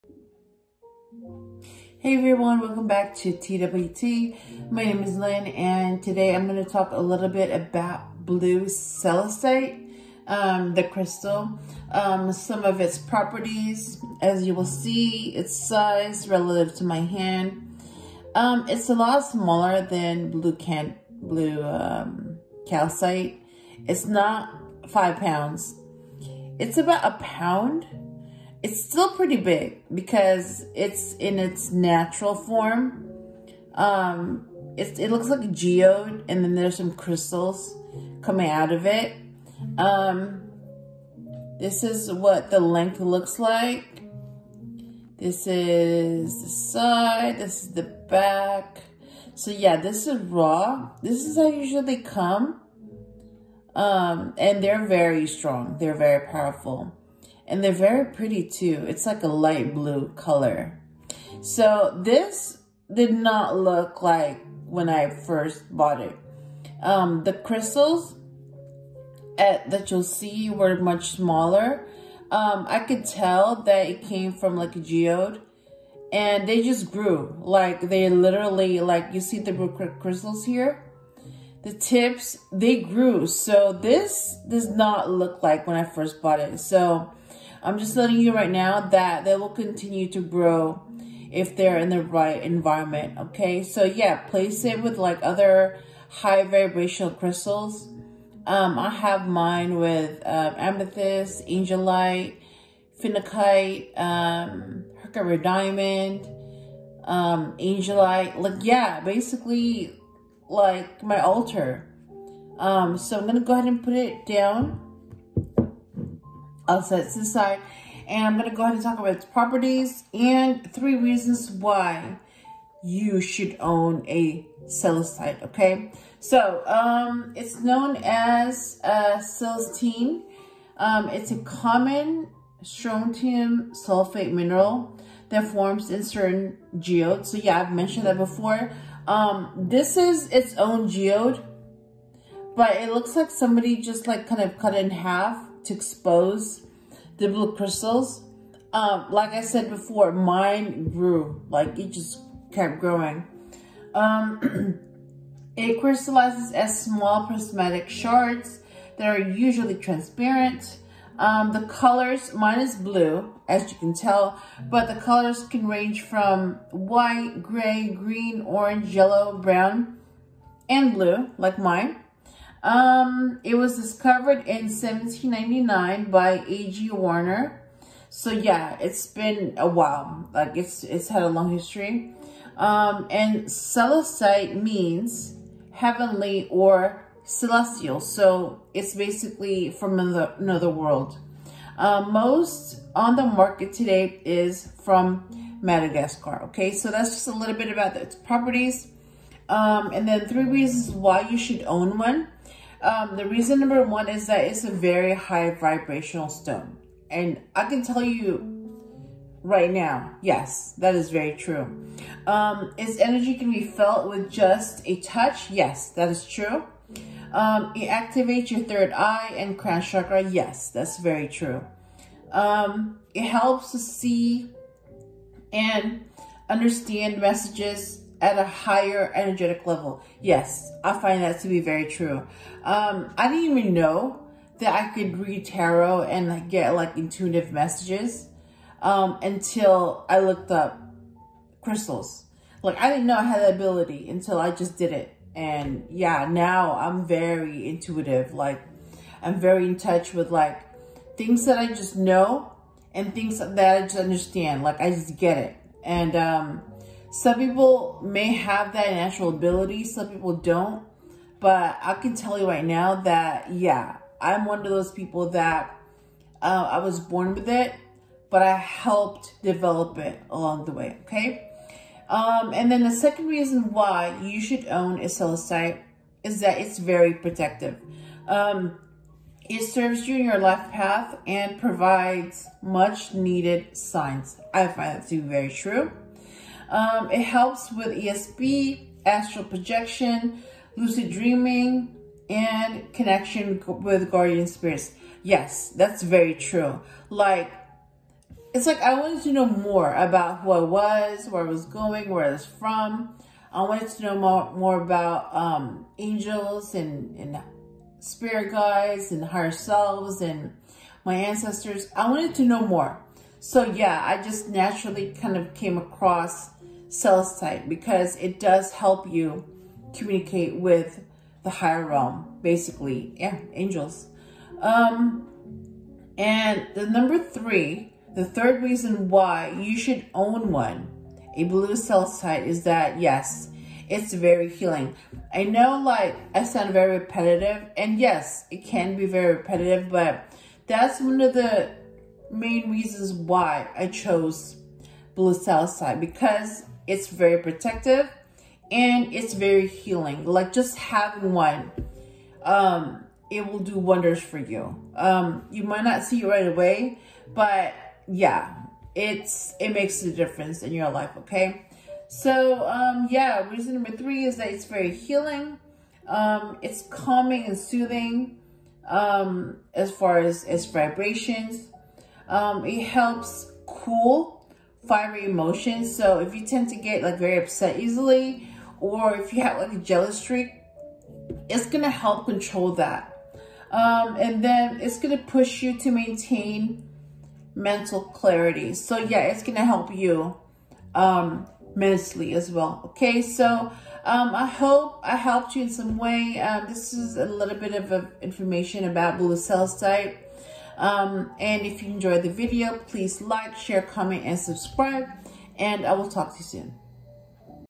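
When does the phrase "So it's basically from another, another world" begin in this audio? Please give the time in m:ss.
3:07.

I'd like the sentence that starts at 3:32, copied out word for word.
Um, its energy can be felt with just a touch.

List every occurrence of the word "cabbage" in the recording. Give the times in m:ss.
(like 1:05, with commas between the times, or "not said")
not said.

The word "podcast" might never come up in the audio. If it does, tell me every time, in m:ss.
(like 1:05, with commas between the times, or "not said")
not said.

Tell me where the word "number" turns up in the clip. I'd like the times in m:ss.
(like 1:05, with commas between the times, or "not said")
3:23, 5:26, 6:03.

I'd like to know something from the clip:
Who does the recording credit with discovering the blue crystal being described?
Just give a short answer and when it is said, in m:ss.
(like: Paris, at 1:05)
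A.G. Werner, at 2:56.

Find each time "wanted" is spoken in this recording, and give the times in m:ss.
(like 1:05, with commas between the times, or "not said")
4:58, 5:03, 5:12.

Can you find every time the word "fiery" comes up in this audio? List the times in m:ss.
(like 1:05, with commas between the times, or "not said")
6:14.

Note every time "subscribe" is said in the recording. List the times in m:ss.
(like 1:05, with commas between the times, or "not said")
6:44.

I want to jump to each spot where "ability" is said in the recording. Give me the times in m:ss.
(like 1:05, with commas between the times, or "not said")
4:03, 4:19.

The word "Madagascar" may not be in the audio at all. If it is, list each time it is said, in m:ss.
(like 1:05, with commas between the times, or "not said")
3:15.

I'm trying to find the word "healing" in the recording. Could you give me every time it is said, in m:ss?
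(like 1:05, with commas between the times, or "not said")
5:34, 5:49, 6:04.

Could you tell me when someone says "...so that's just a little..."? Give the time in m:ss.
3:16.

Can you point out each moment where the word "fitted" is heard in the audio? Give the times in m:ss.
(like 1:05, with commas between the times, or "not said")
not said.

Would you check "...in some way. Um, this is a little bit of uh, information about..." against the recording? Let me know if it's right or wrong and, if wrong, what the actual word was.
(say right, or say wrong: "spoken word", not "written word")
right.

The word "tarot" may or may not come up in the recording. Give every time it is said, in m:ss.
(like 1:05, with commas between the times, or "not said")
3:55.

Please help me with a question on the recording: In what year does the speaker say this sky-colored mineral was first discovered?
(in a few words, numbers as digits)
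1799.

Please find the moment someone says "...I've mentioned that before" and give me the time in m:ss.
2:17.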